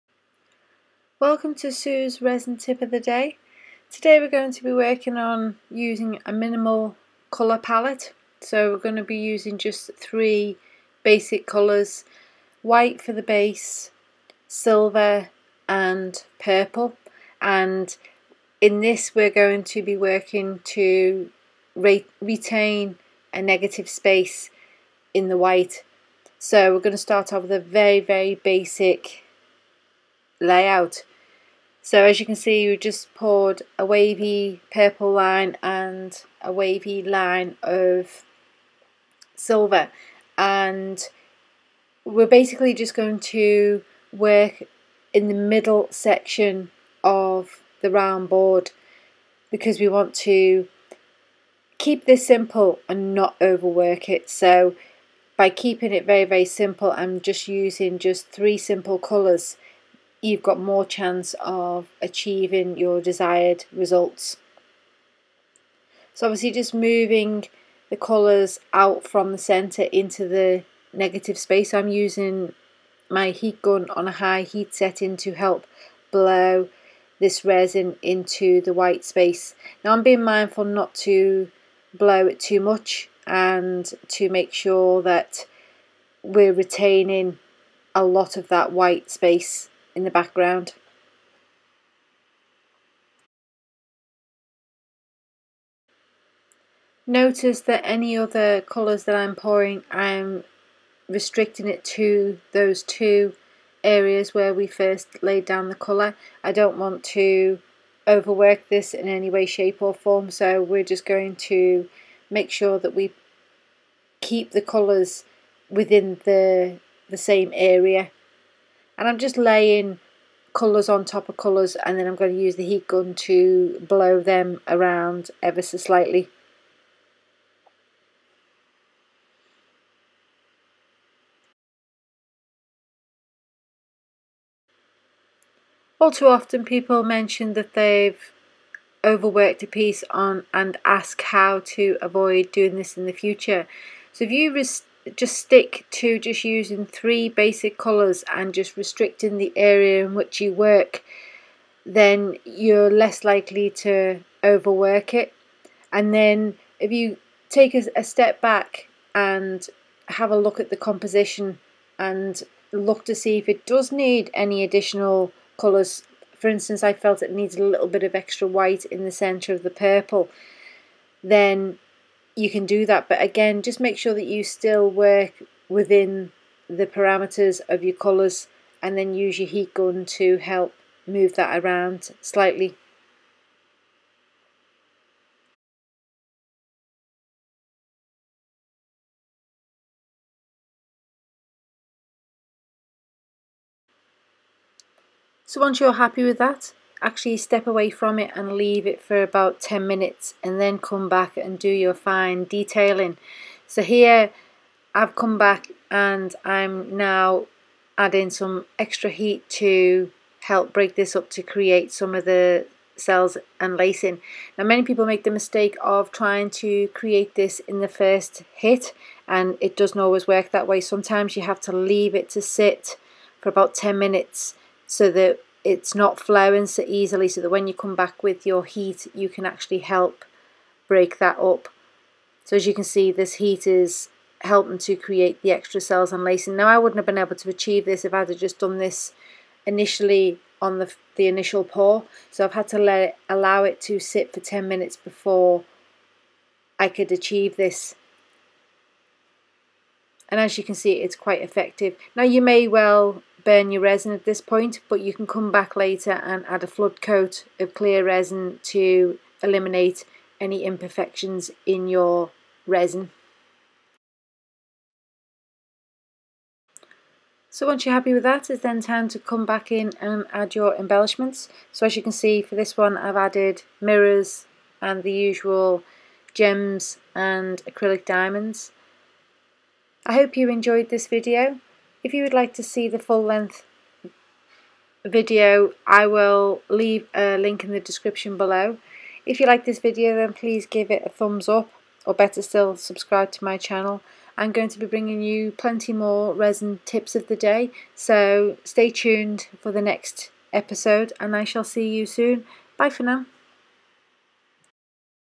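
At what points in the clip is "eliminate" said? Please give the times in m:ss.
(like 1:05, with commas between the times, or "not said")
4:19.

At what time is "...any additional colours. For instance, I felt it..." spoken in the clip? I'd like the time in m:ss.
2:44.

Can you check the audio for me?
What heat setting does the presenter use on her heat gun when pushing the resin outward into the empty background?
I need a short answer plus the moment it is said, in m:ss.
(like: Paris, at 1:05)
high, at 1:14.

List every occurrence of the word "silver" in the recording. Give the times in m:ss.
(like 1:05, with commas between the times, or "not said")
0:14, 0:39.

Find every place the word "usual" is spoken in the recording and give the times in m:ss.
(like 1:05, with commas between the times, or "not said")
4:35.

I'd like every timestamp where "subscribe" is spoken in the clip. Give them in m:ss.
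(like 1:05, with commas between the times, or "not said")
4:52.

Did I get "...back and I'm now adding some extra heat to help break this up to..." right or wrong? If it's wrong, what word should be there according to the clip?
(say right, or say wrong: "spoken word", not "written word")
right.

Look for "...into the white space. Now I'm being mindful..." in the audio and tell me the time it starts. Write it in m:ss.
1:18.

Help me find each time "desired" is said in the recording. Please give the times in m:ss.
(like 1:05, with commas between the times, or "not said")
1:03.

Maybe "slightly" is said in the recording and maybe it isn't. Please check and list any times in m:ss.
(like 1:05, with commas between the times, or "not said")
2:05, 3:02.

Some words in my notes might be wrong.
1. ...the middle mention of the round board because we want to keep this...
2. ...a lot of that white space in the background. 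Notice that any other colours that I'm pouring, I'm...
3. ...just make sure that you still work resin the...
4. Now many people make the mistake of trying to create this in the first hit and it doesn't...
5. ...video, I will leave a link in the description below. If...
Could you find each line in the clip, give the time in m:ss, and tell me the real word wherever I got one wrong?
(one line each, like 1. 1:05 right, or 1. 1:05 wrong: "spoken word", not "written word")
1. 0:45 wrong: "section", not "mention"
2. 1:27 right
3. 2:53 wrong: "within", not "resin"
4. 3:34 right
5. 4:45 right.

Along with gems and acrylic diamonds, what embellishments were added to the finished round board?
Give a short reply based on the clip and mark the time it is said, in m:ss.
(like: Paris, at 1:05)
mirrors, at 4:33.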